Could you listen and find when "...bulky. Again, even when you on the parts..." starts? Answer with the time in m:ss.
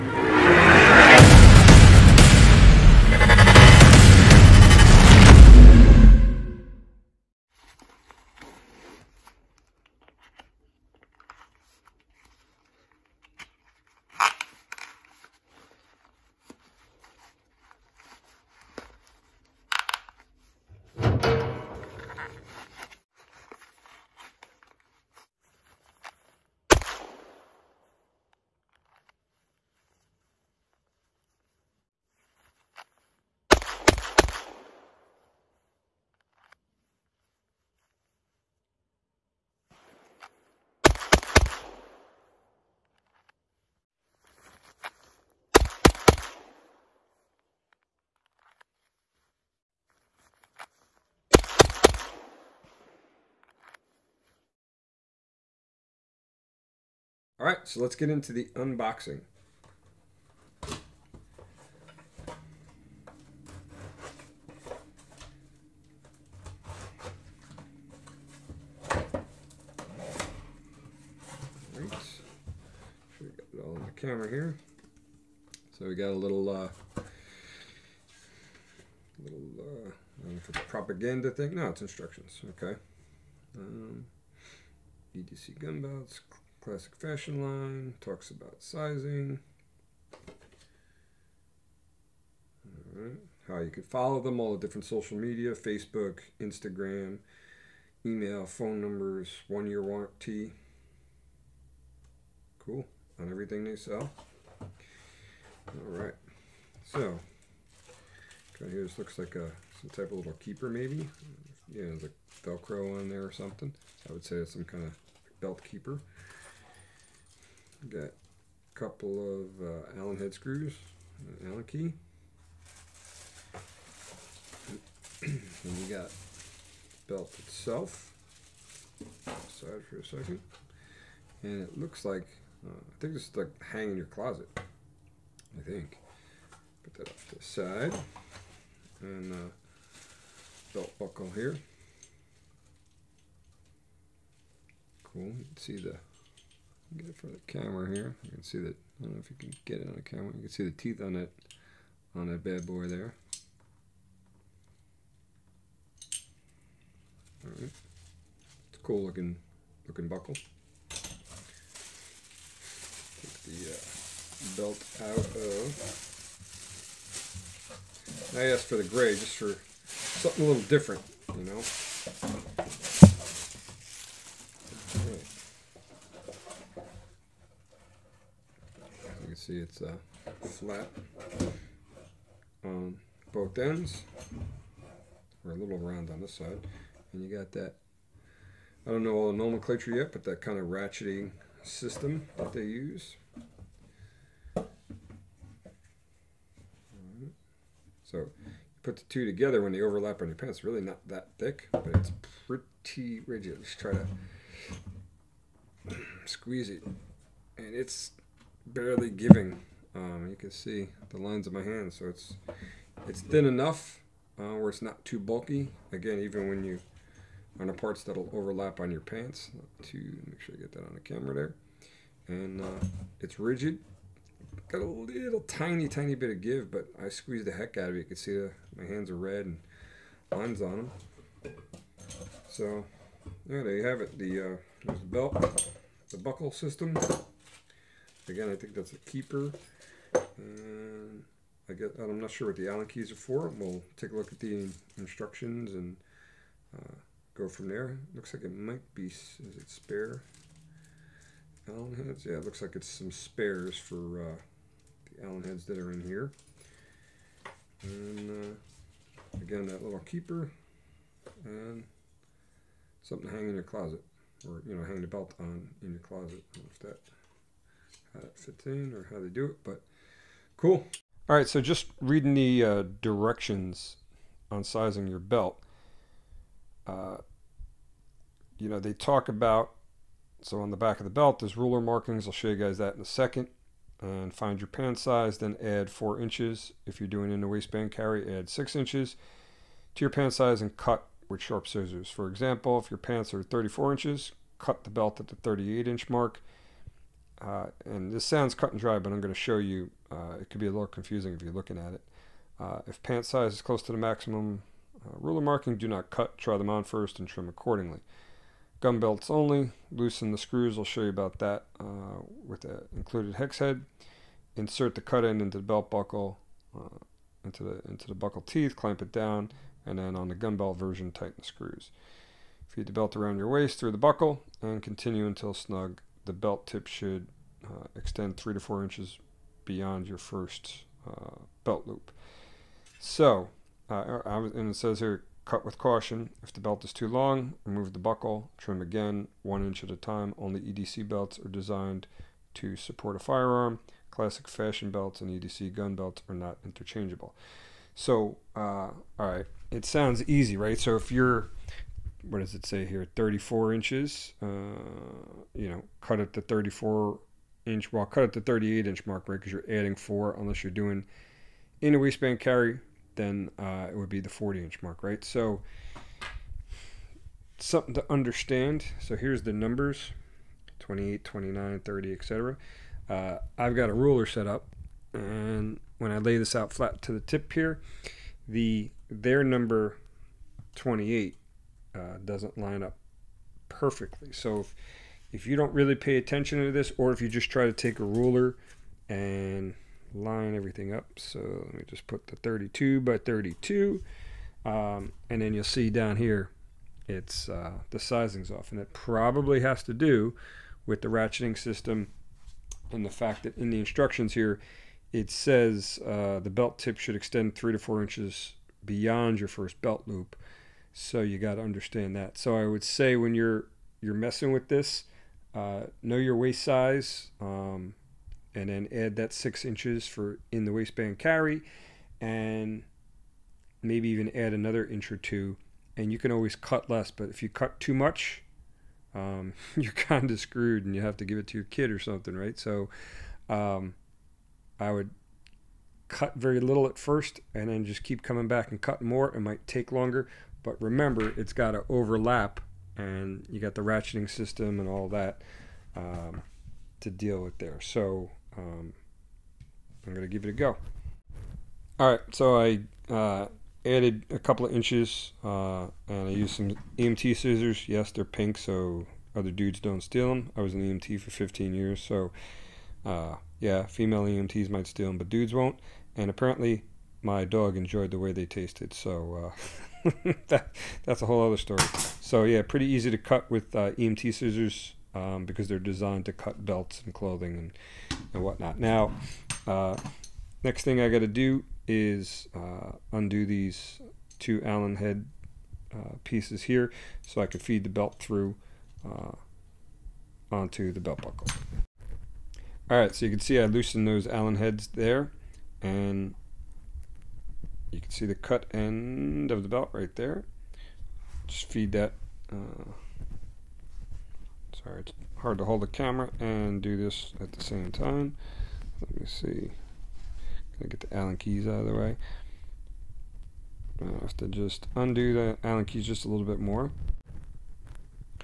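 3:35.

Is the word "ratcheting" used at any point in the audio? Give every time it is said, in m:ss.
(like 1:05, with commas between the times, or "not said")
3:10, 6:41, 7:23.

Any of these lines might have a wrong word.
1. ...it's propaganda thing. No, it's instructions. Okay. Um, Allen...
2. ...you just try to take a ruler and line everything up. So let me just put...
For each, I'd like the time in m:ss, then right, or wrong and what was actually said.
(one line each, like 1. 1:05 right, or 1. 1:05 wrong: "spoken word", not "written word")
1. 1:20 wrong: "EDC", not "Allen"
2. 6:27 right.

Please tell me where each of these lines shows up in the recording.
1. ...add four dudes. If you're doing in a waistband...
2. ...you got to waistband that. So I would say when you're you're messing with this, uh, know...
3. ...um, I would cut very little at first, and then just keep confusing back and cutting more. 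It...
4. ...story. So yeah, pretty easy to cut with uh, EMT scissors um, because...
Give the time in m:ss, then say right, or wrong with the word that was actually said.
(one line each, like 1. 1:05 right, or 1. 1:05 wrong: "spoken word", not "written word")
1. 4:45 wrong: "inches", not "dudes"
2. 6:51 wrong: "understand", not "waistband"
3. 7:13 wrong: "coming", not "confusing"
4. 7:51 right.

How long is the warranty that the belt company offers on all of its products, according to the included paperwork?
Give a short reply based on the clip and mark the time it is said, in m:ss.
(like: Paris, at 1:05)
1 year, at 1:39.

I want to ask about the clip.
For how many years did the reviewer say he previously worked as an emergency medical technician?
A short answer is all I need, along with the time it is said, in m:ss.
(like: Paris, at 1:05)
15 years, at 7:41.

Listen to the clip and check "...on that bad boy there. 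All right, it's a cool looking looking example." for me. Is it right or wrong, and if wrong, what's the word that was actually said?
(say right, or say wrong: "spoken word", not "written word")
wrong: "buckle", not "example".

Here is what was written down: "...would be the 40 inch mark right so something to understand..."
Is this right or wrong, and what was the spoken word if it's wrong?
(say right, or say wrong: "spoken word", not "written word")
right.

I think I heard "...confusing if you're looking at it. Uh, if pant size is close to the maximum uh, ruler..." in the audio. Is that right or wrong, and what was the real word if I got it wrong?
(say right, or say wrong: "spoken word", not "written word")
right.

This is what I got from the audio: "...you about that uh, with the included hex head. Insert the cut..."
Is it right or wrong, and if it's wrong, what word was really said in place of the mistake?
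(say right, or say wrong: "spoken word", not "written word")
right.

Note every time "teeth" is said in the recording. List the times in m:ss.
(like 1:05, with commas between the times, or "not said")
2:30, 5:18.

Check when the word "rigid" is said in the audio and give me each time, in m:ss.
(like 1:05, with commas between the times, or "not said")
3:23, 3:43.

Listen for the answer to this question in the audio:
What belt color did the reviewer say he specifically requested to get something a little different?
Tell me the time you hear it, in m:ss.
2:48.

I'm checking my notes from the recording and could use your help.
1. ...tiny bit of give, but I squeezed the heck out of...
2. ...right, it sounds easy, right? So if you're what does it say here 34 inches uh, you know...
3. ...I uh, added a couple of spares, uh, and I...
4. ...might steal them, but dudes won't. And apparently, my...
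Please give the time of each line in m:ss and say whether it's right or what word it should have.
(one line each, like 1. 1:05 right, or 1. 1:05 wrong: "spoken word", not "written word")
1. 3:45 right
2. 5:49 right
3. 7:32 wrong: "inches", not "spares"
4. 7:44 right.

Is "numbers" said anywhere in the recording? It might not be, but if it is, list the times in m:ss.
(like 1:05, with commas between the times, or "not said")
1:38, 6:09, 6:19.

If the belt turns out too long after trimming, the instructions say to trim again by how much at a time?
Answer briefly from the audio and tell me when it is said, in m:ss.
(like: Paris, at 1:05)
1 inch, at 5:39.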